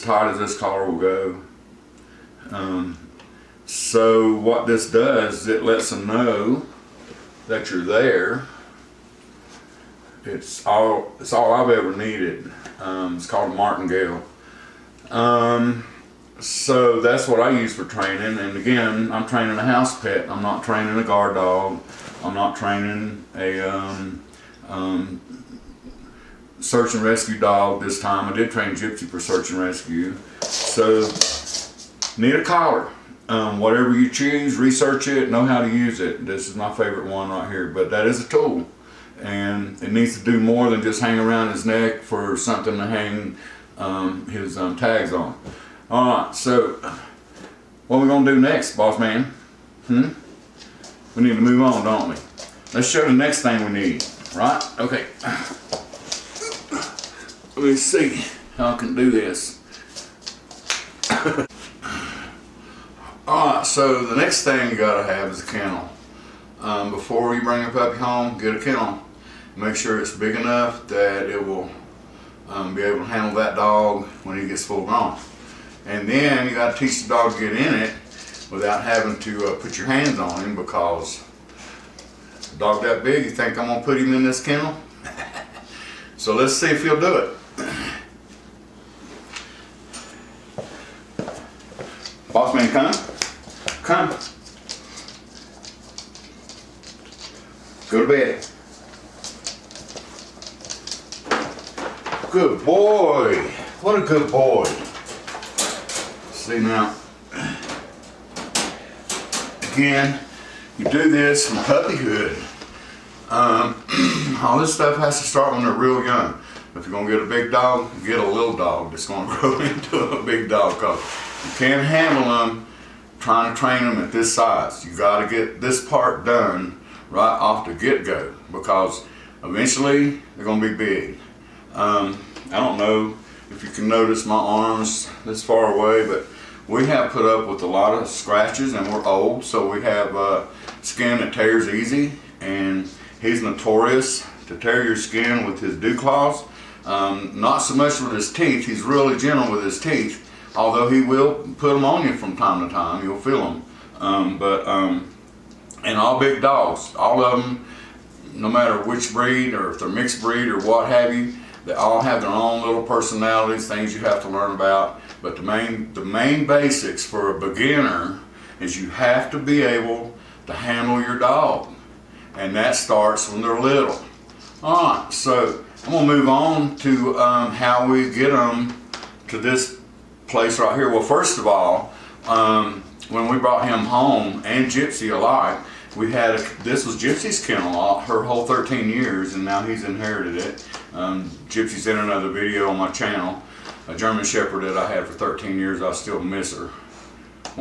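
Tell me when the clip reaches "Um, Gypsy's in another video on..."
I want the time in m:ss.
3:10.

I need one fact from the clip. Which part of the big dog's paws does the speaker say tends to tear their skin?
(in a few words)
dew claws.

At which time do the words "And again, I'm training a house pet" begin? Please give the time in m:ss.
0:18.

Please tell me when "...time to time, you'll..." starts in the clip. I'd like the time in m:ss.
2:32.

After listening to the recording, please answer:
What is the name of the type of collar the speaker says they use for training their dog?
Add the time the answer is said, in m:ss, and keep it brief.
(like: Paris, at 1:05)
martingale, at 0:13.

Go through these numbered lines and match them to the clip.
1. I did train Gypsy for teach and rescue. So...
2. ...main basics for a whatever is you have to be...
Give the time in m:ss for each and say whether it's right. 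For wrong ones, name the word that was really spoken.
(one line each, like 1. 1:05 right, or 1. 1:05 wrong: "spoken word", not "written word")
1. 0:28 wrong: "search", not "teach"
2. 2:46 wrong: "beginner", not "whatever".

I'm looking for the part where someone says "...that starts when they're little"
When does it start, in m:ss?
2:52.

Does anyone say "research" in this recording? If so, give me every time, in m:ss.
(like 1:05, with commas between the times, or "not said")
0:34.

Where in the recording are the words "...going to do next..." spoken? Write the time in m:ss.
0:48.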